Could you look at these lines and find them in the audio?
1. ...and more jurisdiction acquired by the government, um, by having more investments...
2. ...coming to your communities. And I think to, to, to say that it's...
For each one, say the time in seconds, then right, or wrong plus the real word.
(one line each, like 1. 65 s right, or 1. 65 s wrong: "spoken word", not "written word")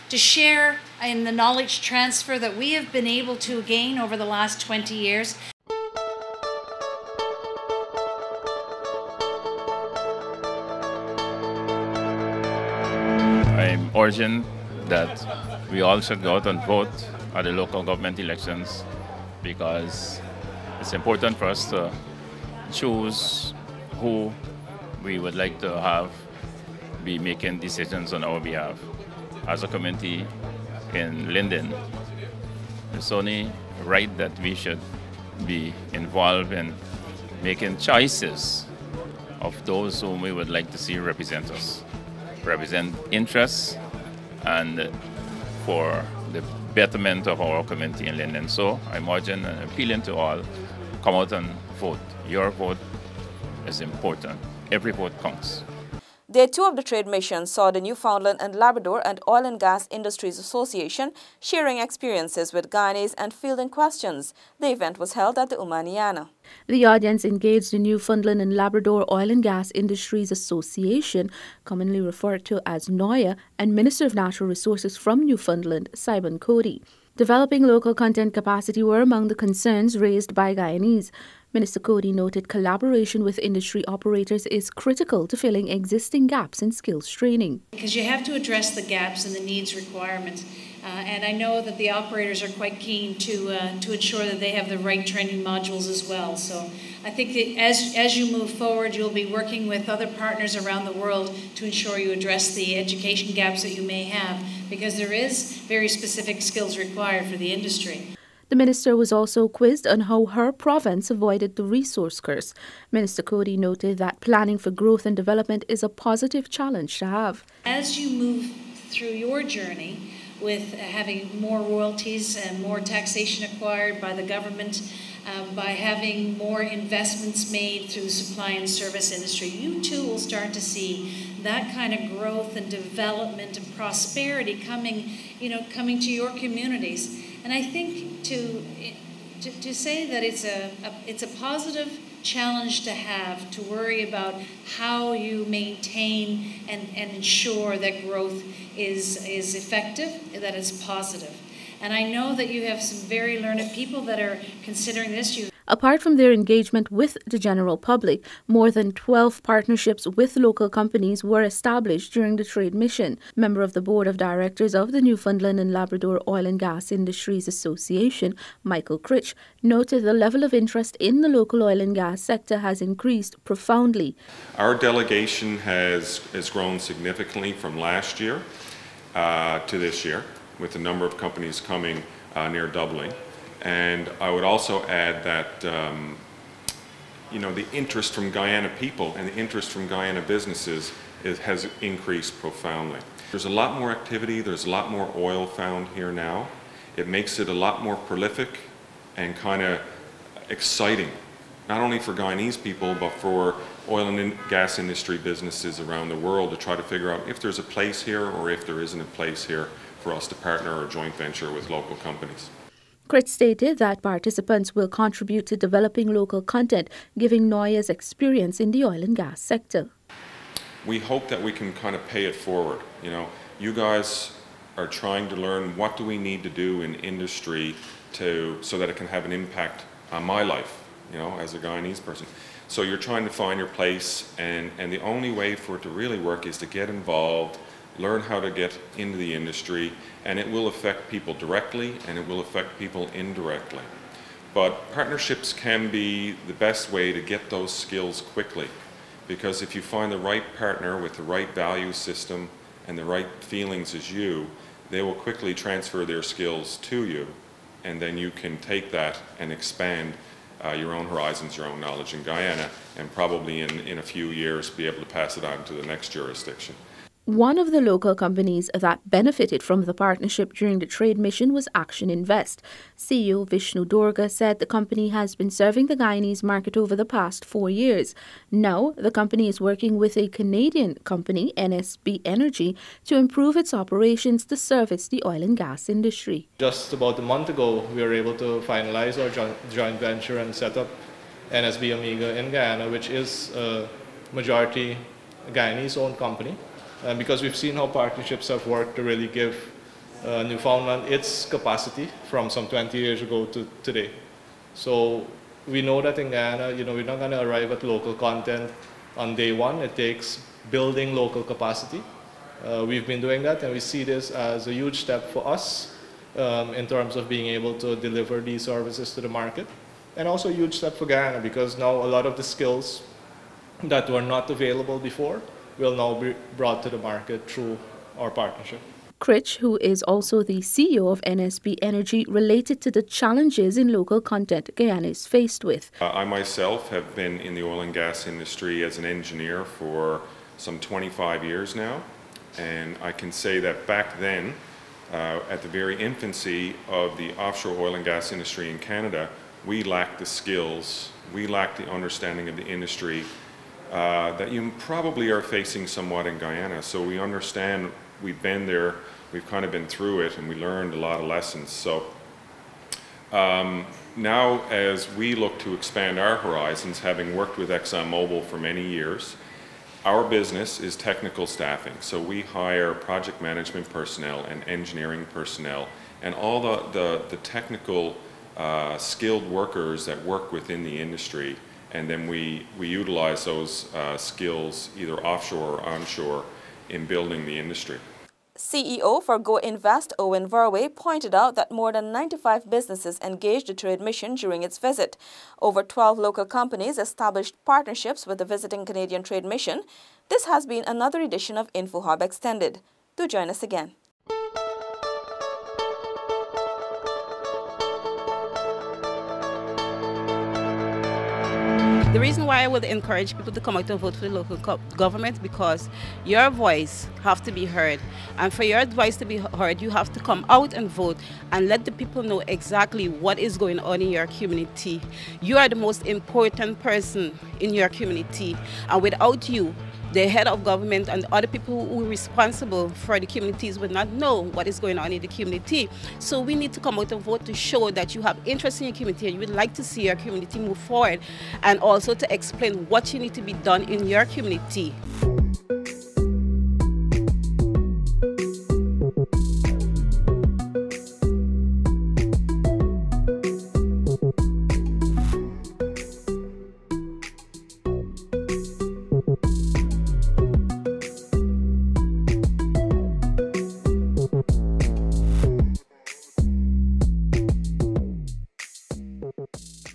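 1. 122 s wrong: "taxation", not "jurisdiction"
2. 135 s right.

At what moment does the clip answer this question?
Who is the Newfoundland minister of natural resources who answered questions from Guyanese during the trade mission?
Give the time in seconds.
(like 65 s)
75 s.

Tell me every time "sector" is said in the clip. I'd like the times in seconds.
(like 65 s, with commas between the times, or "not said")
172 s, 219 s.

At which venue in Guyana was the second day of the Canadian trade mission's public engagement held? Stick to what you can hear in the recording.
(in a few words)
Umana Yana.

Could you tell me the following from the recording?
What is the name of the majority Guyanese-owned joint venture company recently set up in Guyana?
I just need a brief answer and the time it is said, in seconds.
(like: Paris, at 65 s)
NSB Omega, at 291 s.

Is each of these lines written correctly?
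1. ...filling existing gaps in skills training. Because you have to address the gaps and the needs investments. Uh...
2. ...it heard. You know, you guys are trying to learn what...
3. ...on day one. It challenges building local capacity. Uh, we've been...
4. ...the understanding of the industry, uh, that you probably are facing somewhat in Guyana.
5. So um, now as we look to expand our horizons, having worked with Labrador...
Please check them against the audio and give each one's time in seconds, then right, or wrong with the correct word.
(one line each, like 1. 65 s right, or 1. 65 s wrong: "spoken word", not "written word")
1. 85 s wrong: "requirements", not "investments"
2. 222 s wrong: "forward", not "heard"
3. 309 s wrong: "takes", not "challenges"
4. 351 s right
5. 361 s wrong: "ExxonMobil", not "Labrador".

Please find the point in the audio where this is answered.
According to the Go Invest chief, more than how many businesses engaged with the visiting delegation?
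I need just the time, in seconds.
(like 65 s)
392 s.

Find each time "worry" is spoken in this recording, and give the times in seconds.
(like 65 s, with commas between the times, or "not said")
143 s.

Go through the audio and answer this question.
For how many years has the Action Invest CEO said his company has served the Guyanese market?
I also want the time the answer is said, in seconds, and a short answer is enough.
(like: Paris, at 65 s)
4 years, at 277 s.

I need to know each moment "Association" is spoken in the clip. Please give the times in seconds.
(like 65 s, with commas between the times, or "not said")
60 s, 70 s, 167 s.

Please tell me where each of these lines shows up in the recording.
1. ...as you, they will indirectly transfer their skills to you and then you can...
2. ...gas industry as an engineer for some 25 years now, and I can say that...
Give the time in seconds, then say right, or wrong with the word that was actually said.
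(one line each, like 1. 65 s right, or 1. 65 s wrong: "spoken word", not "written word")
1. 253 s wrong: "quickly", not "indirectly"
2. 337 s right.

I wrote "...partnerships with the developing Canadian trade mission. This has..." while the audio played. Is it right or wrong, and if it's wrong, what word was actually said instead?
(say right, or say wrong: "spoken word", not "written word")
wrong: "visiting", not "developing".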